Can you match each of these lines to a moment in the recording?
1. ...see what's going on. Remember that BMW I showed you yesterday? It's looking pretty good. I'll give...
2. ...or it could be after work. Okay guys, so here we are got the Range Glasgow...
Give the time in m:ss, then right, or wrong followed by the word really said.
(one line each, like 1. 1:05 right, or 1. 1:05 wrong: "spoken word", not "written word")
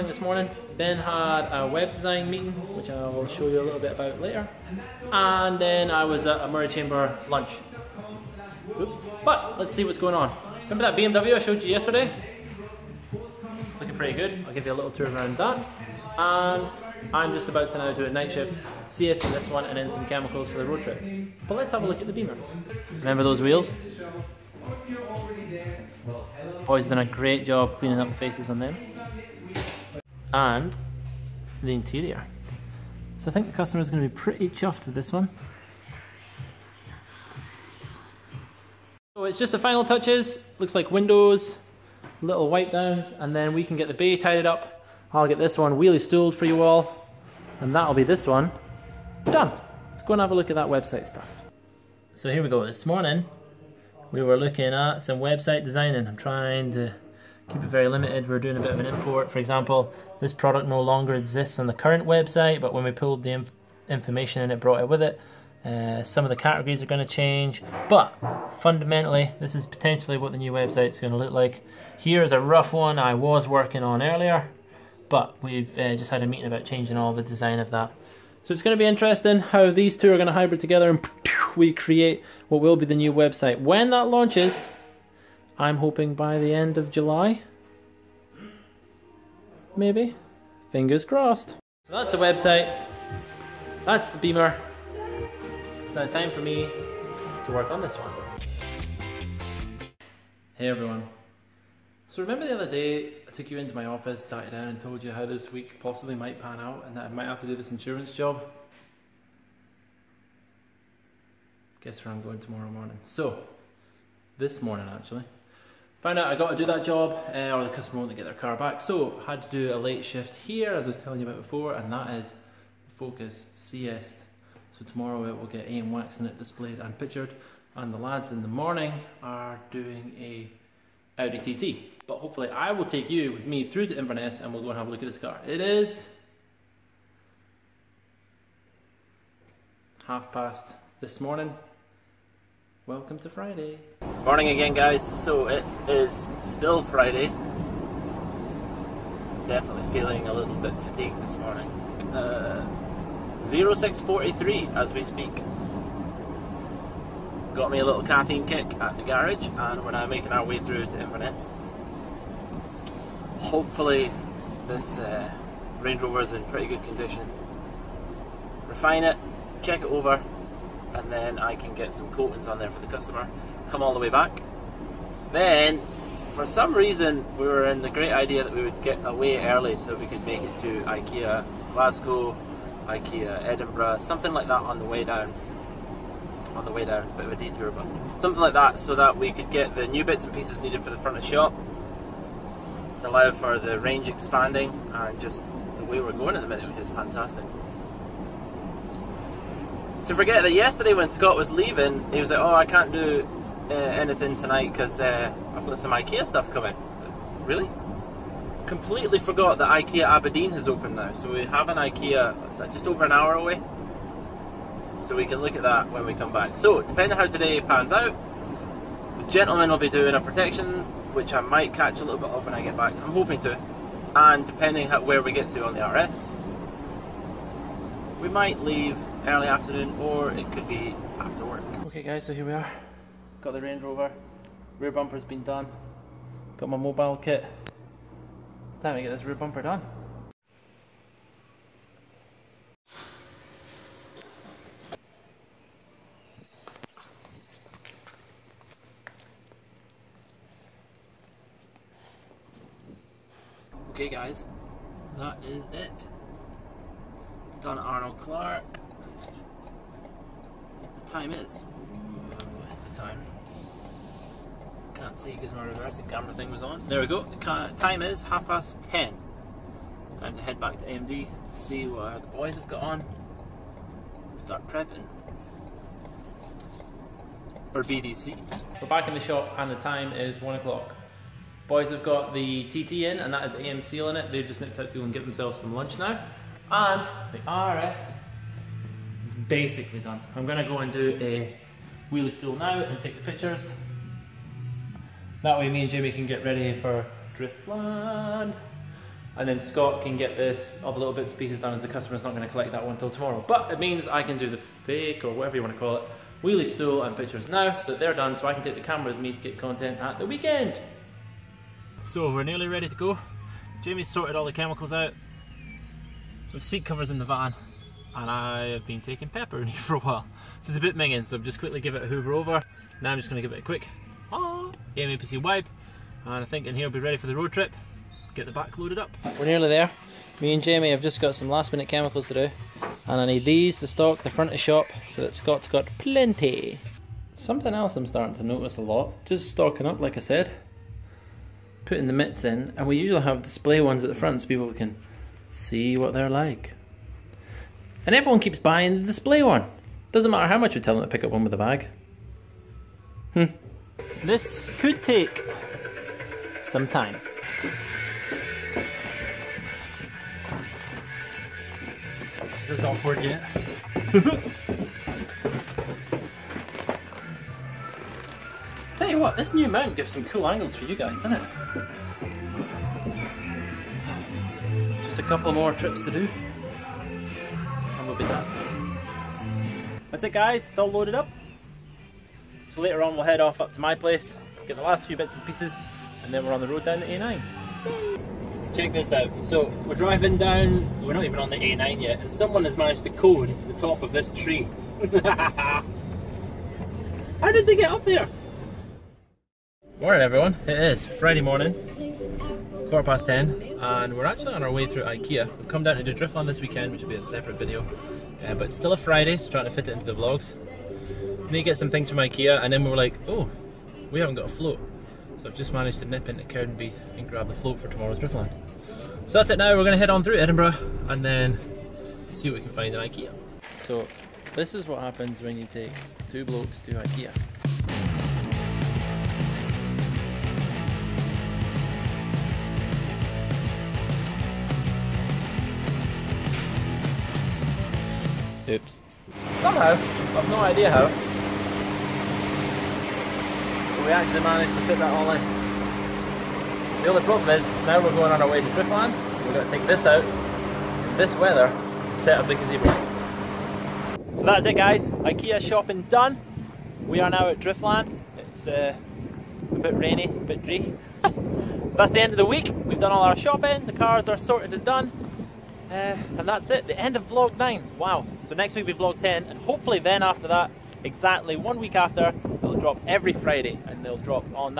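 1. 0:09 right
2. 3:49 wrong: "Rover", not "Glasgow".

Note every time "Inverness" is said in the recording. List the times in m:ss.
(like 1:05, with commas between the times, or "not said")
2:13, 2:41.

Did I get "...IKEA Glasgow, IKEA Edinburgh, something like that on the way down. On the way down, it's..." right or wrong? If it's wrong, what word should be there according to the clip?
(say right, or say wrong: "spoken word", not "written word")
right.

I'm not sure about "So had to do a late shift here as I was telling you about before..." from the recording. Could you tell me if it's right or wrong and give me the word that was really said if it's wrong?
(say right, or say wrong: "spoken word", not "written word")
right.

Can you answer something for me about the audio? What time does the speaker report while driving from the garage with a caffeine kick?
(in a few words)
06:43.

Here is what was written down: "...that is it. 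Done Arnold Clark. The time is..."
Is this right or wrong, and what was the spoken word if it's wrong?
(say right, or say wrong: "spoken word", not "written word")
right.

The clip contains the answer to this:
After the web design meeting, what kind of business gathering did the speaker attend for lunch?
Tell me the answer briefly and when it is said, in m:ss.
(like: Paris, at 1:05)
Moray Chamber lunch, at 0:06.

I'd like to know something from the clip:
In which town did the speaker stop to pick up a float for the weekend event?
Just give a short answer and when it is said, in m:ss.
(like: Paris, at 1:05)
Cowdenbeath, at 6:56.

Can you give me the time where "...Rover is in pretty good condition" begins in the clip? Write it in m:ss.
2:46.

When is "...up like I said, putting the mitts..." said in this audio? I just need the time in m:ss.
5:39.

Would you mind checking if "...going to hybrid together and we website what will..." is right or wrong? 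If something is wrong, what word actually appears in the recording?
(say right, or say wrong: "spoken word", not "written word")
wrong: "create", not "website".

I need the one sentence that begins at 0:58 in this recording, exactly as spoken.
We're doing a bit of an import.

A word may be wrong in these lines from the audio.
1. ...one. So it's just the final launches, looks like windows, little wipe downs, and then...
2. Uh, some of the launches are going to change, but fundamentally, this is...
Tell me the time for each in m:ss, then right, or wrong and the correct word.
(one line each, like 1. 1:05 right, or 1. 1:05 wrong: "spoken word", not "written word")
1. 0:35 wrong: "touches", not "launches"
2. 1:05 wrong: "categories", not "launches".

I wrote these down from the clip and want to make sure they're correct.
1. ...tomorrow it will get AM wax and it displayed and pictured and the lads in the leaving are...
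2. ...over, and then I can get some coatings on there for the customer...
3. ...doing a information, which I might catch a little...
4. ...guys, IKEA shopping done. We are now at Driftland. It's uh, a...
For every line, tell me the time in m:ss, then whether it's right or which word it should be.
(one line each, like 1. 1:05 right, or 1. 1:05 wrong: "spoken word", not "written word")
1. 2:04 wrong: "morning", not "leaving"
2. 2:49 right
3. 3:39 wrong: "protection", not "information"
4. 7:34 right.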